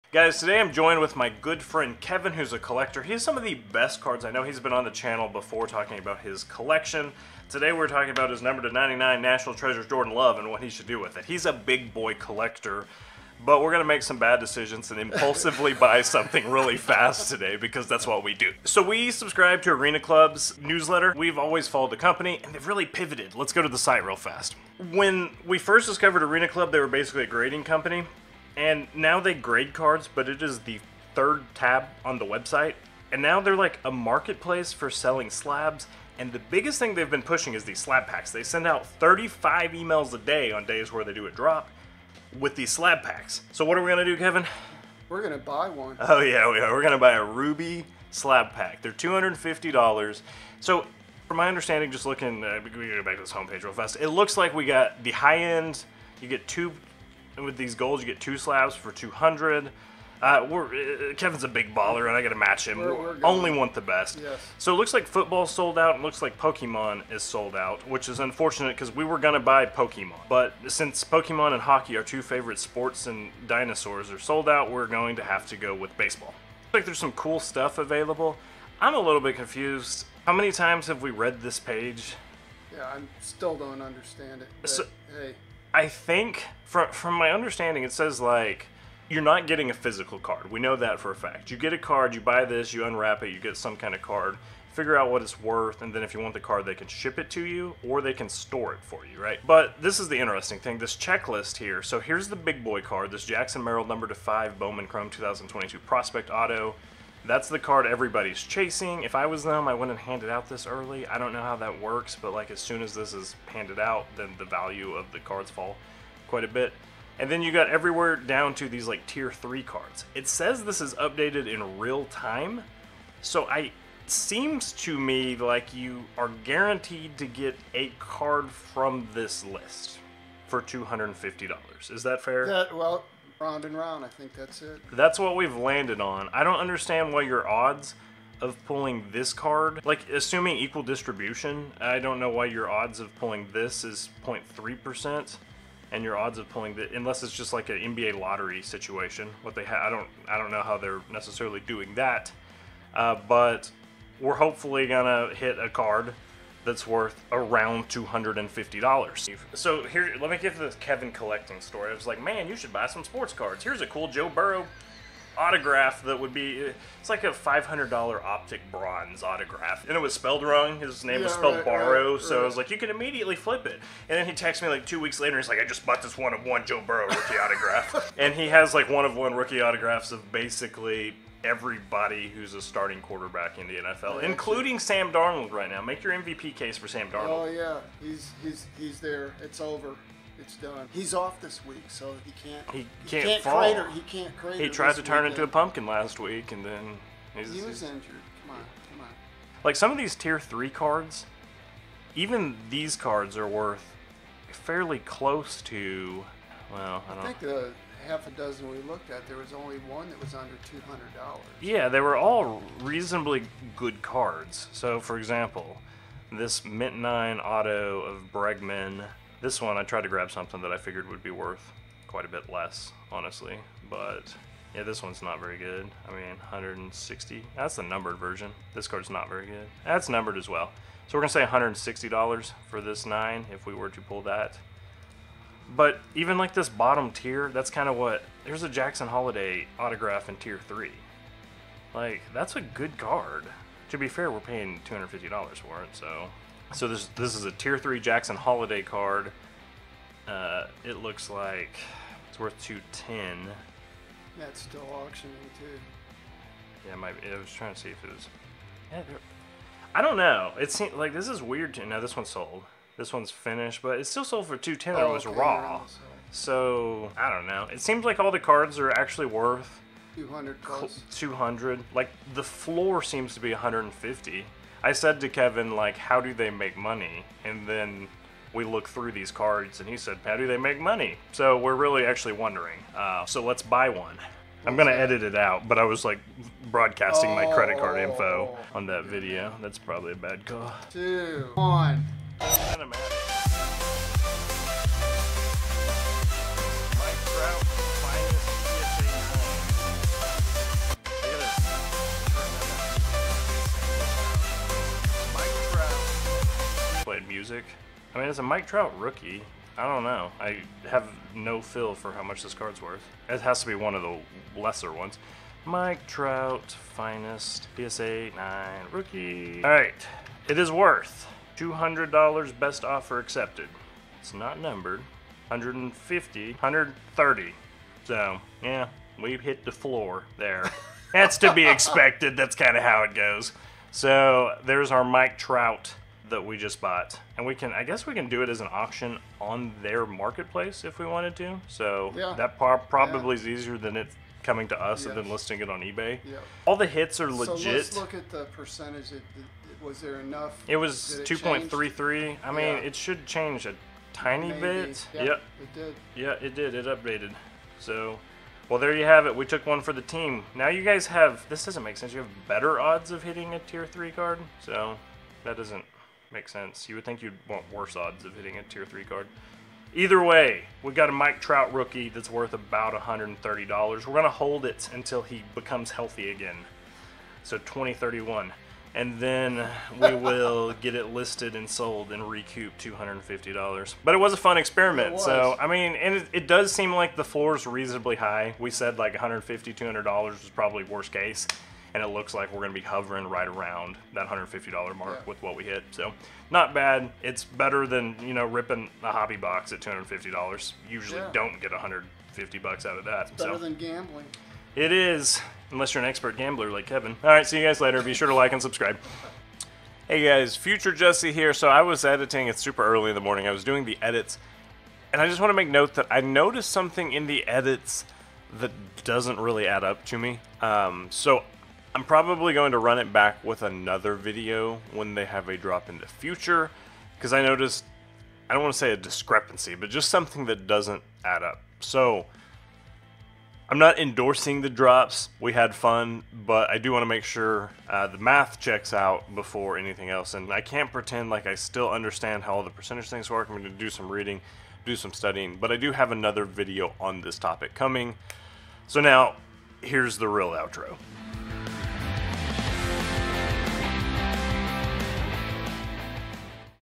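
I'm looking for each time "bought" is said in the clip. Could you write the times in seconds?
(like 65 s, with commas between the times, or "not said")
175 s, 336 s.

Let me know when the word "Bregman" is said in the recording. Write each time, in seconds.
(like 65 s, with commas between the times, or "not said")
218 s.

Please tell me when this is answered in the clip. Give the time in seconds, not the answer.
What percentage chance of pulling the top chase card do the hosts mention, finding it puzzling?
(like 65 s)
144 s.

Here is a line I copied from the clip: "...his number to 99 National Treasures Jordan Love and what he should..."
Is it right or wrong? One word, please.
right.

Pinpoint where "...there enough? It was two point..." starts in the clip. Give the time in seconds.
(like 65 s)
350 s.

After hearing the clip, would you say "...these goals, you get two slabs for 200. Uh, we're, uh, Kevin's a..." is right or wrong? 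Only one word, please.
right.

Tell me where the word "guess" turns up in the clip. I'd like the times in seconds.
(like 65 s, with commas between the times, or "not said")
337 s.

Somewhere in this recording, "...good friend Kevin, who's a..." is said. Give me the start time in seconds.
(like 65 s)
1 s.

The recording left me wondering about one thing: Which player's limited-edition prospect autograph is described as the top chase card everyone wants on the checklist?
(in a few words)
Jackson Merrill.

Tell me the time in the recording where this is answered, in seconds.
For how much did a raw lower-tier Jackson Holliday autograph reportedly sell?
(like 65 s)
264 s.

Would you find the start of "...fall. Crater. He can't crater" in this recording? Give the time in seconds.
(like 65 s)
193 s.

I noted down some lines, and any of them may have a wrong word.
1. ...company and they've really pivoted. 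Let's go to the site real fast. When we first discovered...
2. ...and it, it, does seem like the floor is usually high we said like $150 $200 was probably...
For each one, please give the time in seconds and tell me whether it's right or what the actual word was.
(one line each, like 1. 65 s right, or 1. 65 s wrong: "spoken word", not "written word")
1. 21 s right
2. 385 s wrong: "reasonably", not "usually".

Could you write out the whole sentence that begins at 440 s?
And I can't pretend like I still understand how all the percentage things work.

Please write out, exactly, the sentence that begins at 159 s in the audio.
So here, let me give the Kevin collecting story.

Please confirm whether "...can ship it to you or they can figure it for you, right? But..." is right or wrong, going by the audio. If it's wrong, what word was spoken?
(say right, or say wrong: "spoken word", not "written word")
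wrong: "store", not "figure".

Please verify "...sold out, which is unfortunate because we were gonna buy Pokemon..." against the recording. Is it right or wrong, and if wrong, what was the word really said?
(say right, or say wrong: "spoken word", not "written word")
right.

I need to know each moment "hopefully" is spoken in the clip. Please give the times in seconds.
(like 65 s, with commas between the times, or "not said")
154 s.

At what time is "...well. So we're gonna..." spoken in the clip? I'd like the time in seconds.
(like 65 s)
230 s.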